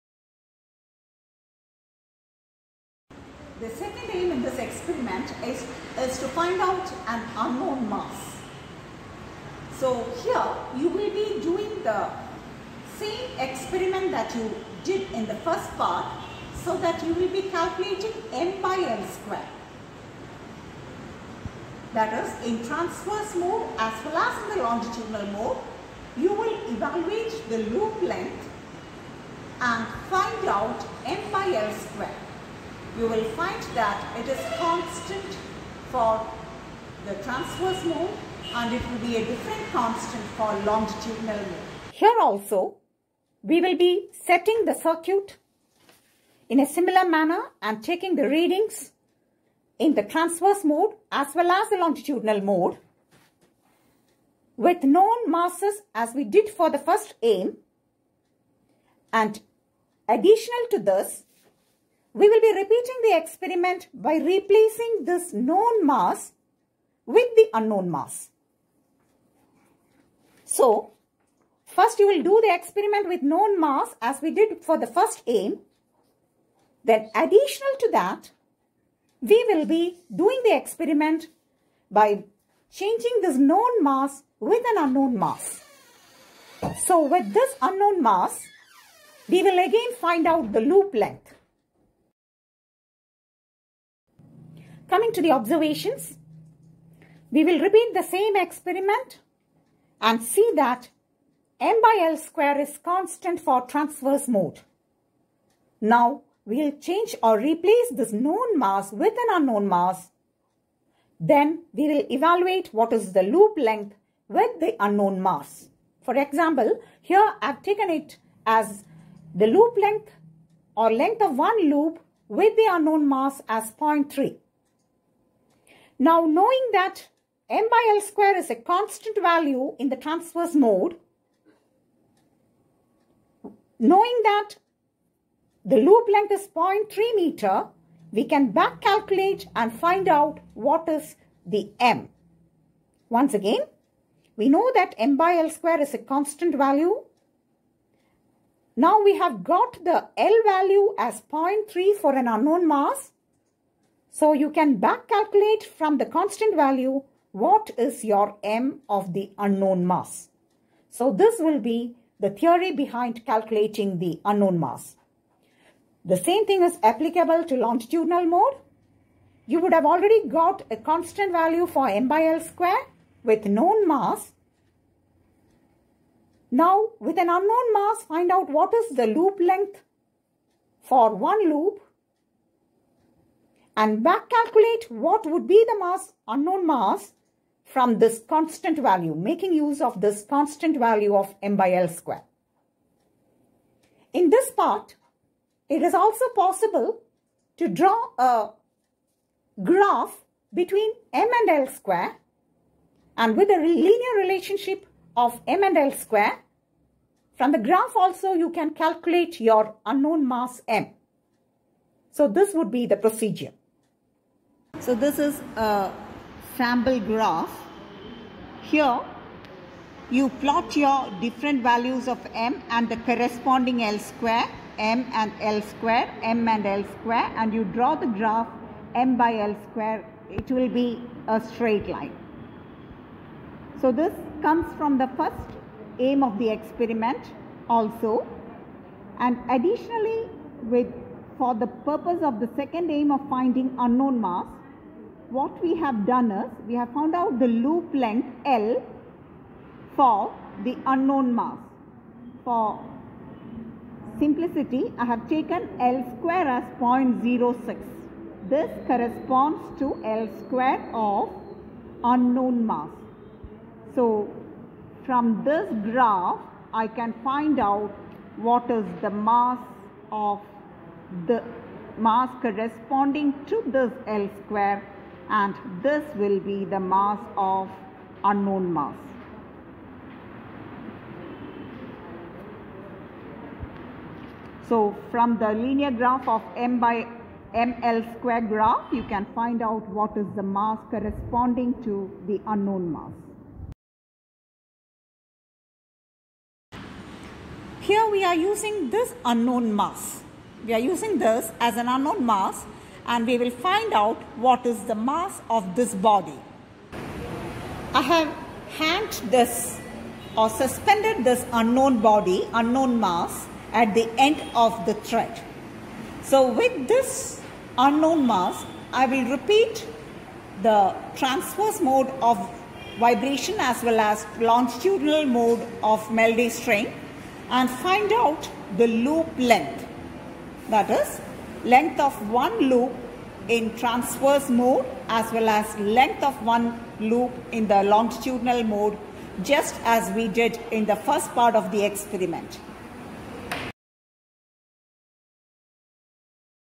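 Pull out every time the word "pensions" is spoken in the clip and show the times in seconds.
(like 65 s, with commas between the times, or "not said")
not said.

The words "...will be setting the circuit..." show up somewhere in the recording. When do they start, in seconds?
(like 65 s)
43 s.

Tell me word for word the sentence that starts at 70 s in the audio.
So, first you will do the experiment with known mass as we did for the first aim.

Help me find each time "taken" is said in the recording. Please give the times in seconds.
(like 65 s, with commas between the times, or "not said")
117 s, 255 s.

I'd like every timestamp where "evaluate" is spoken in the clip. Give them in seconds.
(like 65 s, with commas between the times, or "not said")
26 s, 112 s.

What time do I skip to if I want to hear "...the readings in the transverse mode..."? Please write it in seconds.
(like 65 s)
48 s.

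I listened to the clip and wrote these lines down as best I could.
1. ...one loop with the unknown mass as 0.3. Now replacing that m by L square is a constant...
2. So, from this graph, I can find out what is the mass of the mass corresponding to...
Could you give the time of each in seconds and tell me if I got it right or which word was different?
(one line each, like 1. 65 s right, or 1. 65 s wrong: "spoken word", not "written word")
1. 121 s wrong: "knowing", not "replacing"
2. 263 s right.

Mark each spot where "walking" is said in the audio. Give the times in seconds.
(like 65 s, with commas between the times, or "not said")
not said.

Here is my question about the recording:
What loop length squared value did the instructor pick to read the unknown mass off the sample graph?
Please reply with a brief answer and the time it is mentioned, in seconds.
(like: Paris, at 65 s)
0.06, at 256 s.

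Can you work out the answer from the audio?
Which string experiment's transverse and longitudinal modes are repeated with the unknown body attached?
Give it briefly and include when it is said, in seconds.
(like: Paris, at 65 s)
Melde's string, at 326 s.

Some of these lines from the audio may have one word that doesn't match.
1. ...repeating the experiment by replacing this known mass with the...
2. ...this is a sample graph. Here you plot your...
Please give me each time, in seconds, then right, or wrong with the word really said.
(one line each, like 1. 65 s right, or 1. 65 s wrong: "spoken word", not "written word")
1. 62 s right
2. 214 s right.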